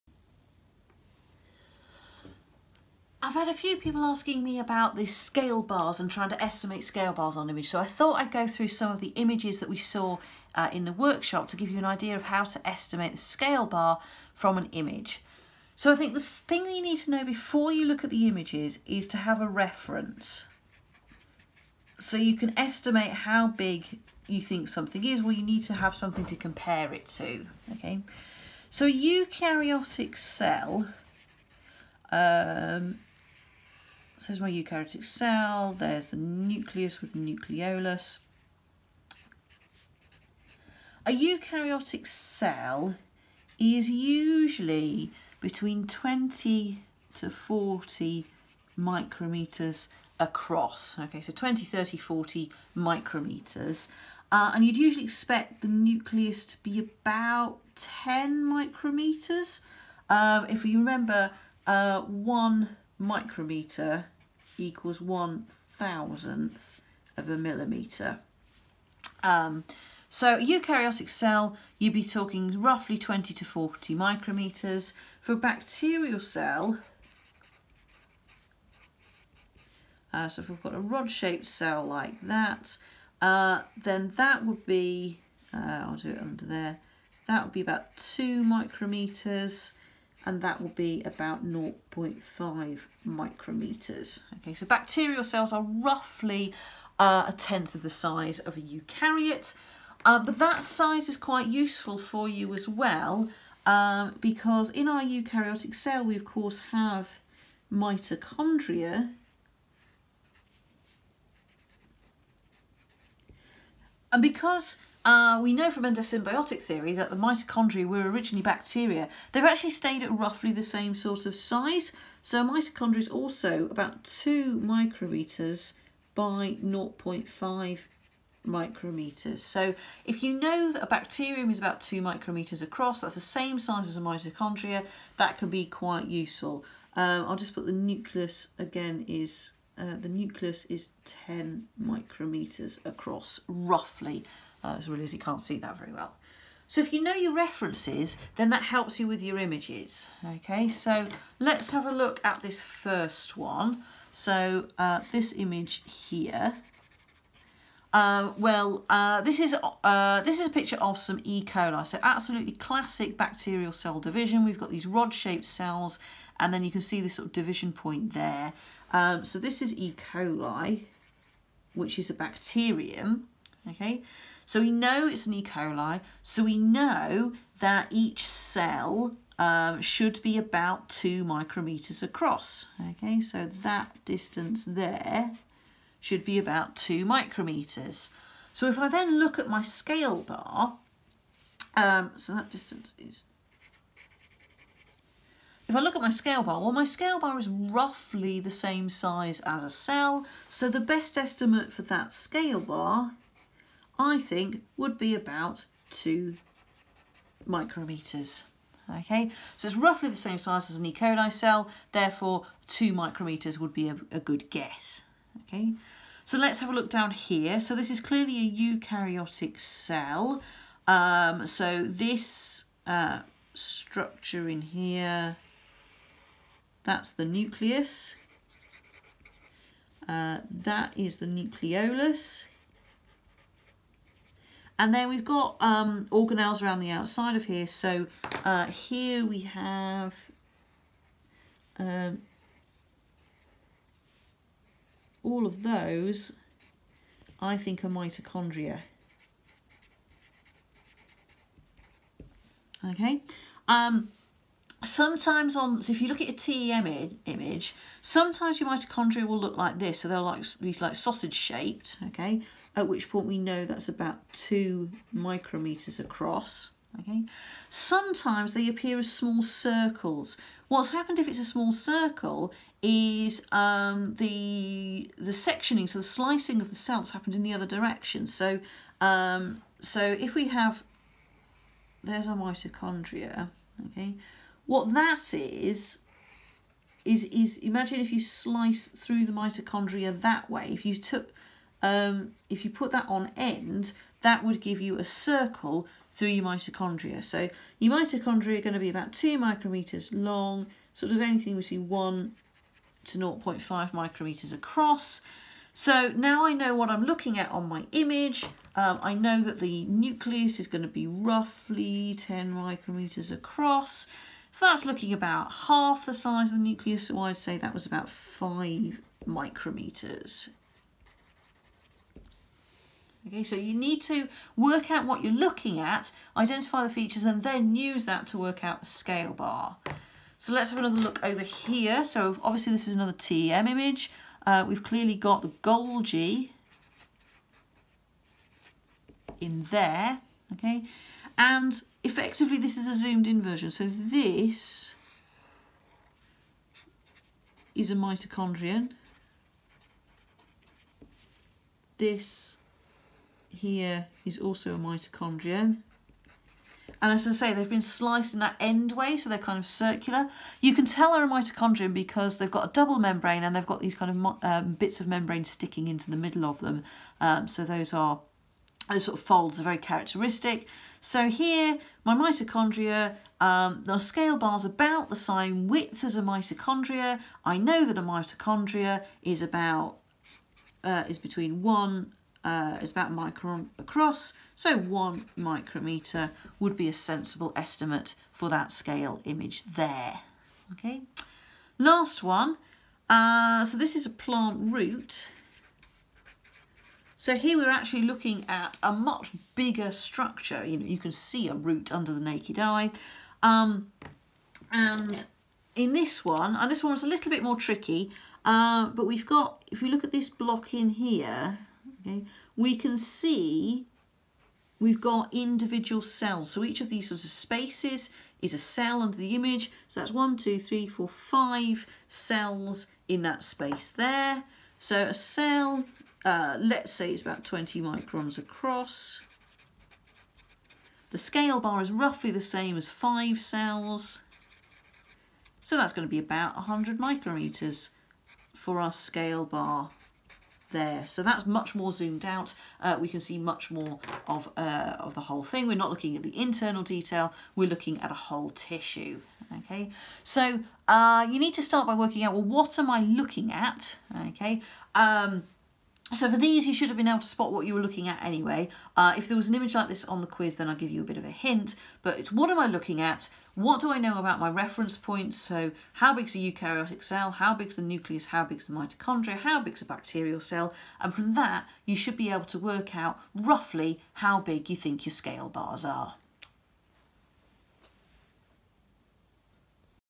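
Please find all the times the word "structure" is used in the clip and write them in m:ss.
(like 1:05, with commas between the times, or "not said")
3:43, 6:39.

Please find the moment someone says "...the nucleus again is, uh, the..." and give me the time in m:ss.
2:17.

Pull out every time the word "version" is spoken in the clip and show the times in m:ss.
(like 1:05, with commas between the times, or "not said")
5:43.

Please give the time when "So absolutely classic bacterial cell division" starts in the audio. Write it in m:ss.
2:41.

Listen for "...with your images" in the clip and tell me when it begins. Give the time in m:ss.
2:29.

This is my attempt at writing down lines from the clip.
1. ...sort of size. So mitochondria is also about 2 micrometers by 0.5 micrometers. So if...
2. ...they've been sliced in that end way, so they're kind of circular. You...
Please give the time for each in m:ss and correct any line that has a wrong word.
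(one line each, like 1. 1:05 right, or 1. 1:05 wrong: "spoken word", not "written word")
1. 2:00 right
2. 5:57 right.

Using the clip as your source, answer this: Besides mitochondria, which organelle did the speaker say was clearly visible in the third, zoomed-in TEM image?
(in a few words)
Golgi.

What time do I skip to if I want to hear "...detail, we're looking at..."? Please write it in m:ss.
7:26.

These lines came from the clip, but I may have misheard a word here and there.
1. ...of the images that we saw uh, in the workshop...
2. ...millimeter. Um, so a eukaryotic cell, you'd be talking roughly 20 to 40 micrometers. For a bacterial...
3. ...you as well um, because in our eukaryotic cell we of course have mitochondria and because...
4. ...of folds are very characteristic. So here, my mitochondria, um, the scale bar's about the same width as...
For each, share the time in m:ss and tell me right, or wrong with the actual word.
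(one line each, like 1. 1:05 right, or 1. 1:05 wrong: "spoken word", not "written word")
1. 0:08 right
2. 1:07 right
3. 1:42 right
4. 6:09 right.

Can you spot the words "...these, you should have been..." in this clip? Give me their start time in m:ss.
7:36.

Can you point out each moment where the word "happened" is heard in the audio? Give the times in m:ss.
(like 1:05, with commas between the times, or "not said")
4:30, 4:37.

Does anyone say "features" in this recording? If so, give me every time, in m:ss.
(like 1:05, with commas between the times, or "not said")
5:26.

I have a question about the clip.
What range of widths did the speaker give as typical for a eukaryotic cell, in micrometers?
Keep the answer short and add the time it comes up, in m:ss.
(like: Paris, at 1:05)
20 to 40 micrometers, at 0:45.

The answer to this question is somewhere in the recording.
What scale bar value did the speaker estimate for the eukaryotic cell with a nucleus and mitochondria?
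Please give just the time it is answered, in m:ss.
5:17.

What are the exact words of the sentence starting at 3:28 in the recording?
Okay, so it's roughly the same size as an E.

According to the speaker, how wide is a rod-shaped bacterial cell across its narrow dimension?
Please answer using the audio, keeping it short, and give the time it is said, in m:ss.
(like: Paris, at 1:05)
0.5 micrometers, at 1:31.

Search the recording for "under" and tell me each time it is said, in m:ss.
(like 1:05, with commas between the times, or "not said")
1:26, 6:41, 6:59.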